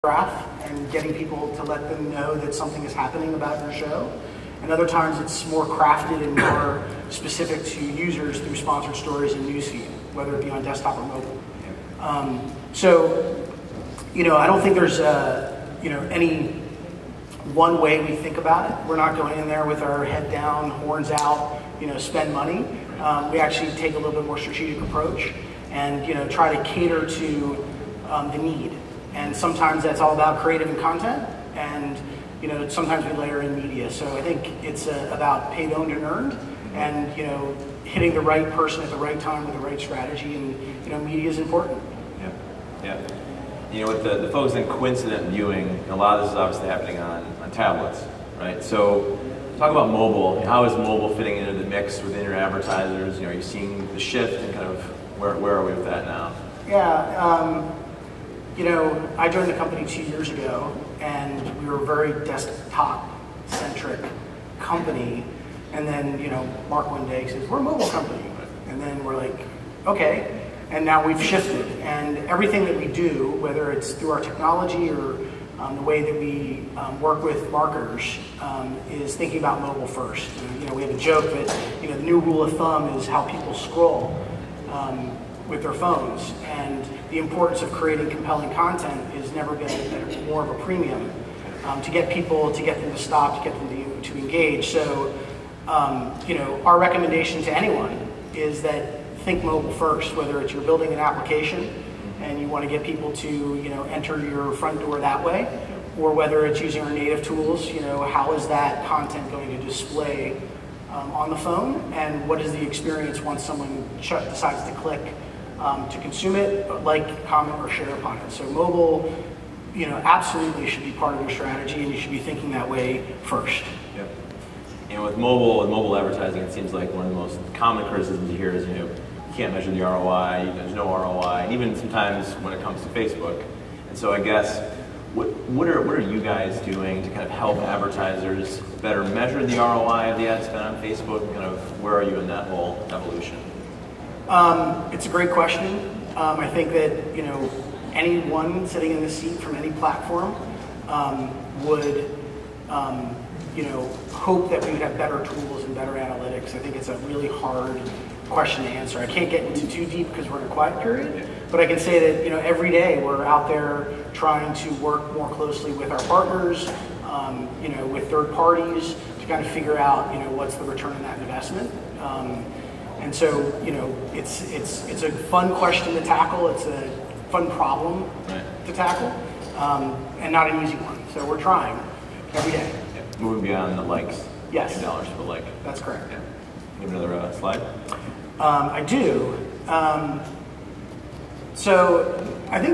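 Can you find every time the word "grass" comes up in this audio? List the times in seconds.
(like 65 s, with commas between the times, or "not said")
not said.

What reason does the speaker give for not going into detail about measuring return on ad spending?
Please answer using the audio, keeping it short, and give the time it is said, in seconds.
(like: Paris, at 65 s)
quiet period, at 160 s.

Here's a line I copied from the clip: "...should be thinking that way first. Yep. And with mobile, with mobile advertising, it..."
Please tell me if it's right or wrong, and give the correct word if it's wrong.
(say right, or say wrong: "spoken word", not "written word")
right.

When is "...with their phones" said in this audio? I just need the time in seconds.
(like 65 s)
85 s.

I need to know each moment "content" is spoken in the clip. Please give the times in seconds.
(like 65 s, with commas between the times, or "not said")
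30 s, 88 s, 108 s.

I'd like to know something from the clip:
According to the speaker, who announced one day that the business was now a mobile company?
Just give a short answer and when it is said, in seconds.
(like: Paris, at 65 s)
Mark, at 66 s.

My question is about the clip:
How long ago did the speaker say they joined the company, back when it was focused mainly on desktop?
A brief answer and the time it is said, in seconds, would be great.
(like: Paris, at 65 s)
2 years, at 59 s.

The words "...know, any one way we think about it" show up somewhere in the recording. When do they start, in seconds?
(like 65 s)
15 s.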